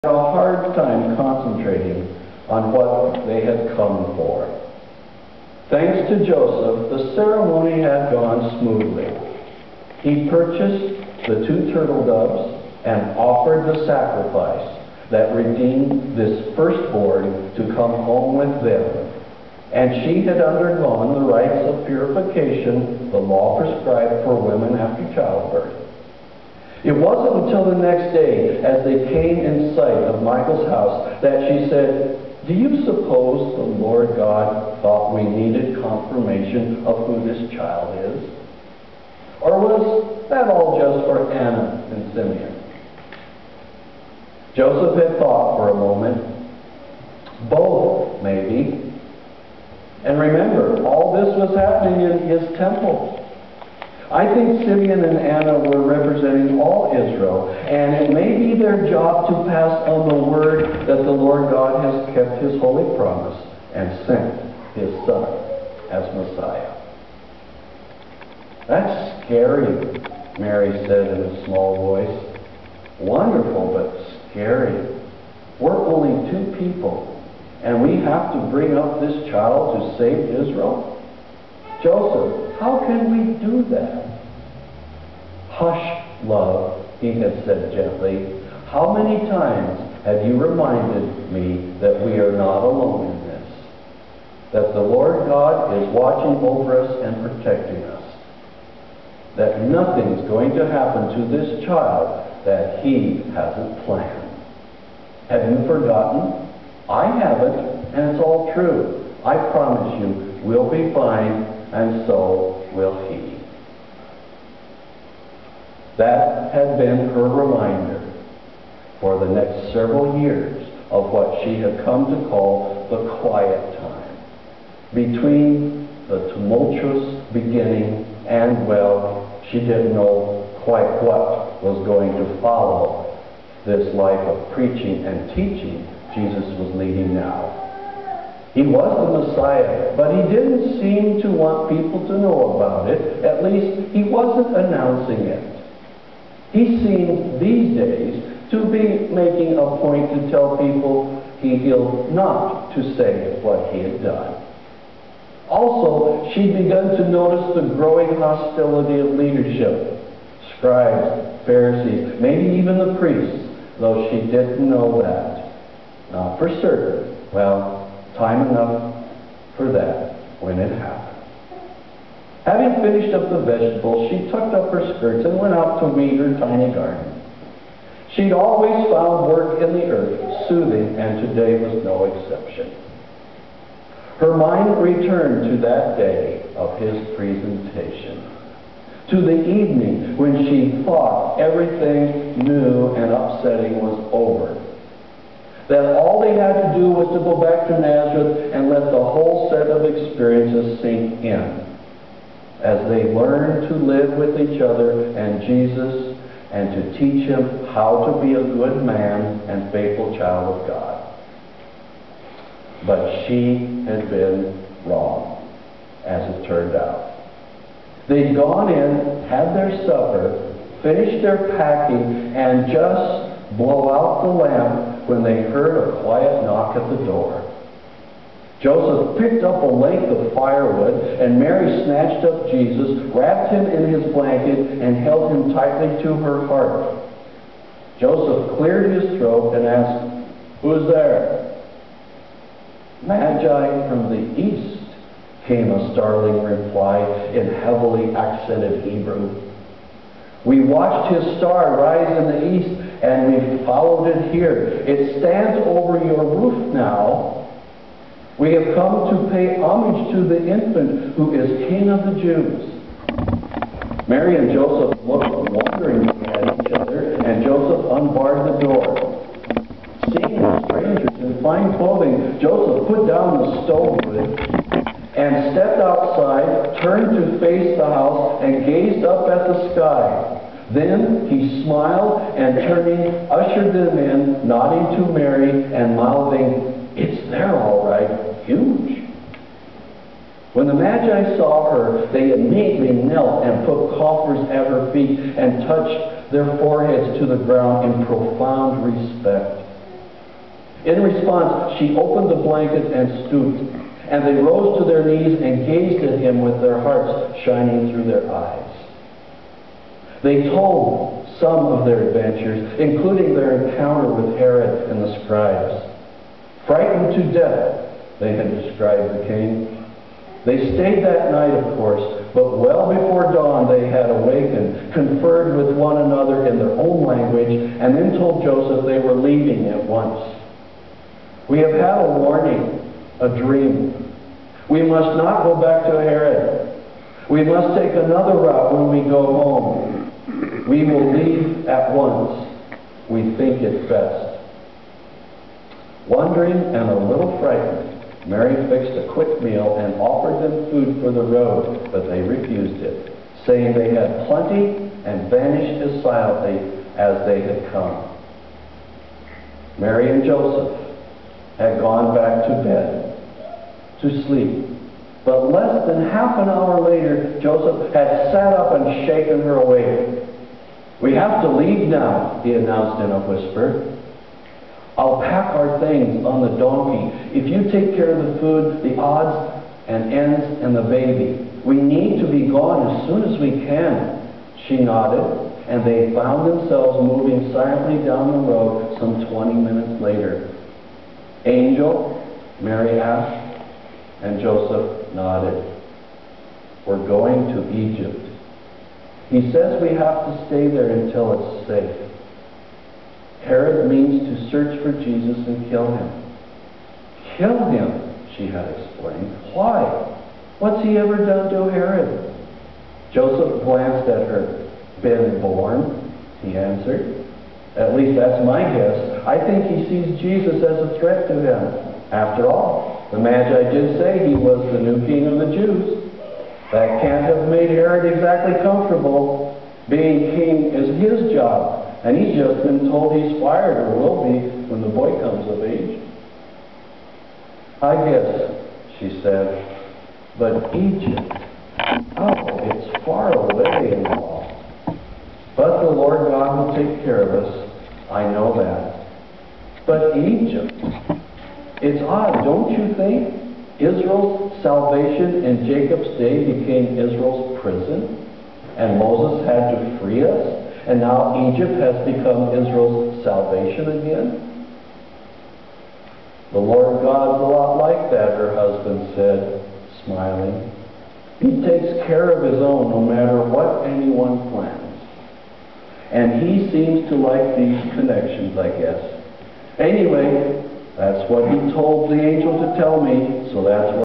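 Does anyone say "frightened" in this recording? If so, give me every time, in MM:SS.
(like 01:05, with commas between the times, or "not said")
05:16, 05:47.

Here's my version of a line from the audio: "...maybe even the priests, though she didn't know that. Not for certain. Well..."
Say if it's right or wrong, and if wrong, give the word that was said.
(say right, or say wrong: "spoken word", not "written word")
right.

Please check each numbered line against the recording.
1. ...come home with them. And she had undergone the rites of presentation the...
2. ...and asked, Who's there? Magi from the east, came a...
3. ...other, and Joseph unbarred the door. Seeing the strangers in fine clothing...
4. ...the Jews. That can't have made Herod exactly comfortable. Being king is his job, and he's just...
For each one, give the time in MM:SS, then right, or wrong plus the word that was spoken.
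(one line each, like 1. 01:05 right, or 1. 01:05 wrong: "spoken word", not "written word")
1. 00:17 wrong: "purification", not "presentation"
2. 03:59 right
3. 04:26 right
4. 07:05 right.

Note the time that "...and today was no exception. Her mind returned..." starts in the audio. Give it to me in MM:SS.
03:00.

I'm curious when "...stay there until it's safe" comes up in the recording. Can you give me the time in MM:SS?
06:40.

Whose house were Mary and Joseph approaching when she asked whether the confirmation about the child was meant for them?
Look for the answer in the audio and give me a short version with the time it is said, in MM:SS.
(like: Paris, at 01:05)
Michael's house, at 00:30.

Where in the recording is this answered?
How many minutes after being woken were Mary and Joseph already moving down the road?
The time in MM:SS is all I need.
06:29.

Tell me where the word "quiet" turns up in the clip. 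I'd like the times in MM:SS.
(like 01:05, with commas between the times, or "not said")
02:03, 03:46.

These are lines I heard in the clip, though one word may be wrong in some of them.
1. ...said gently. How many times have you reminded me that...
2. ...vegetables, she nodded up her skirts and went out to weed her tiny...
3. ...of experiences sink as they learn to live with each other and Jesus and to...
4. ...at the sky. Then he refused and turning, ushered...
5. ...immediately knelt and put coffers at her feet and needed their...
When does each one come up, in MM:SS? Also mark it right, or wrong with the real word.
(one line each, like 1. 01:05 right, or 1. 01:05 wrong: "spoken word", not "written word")
1. 01:27 right
2. 02:53 wrong: "tucked", not "nodded"
3. 03:19 right
4. 04:39 wrong: "smiled", not "refused"
5. 04:52 wrong: "touched", not "needed".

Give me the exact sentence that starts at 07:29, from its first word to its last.
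But Egypt, it's odd, don't you think?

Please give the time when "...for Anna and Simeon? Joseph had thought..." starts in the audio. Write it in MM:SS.
00:41.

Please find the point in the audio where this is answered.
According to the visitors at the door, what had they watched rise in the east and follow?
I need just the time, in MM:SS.
04:11.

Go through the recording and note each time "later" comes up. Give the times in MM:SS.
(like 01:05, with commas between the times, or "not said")
06:06, 06:30.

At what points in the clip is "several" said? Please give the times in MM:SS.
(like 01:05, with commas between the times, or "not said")
01:59.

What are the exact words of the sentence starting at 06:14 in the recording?
I'll pack our things on the donkey.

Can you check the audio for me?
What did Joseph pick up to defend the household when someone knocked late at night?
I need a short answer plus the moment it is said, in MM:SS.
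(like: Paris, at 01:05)
a length of firewood, at 03:49.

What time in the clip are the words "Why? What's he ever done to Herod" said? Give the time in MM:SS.
06:49.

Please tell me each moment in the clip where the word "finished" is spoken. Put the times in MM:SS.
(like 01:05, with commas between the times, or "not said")
02:52, 03:40.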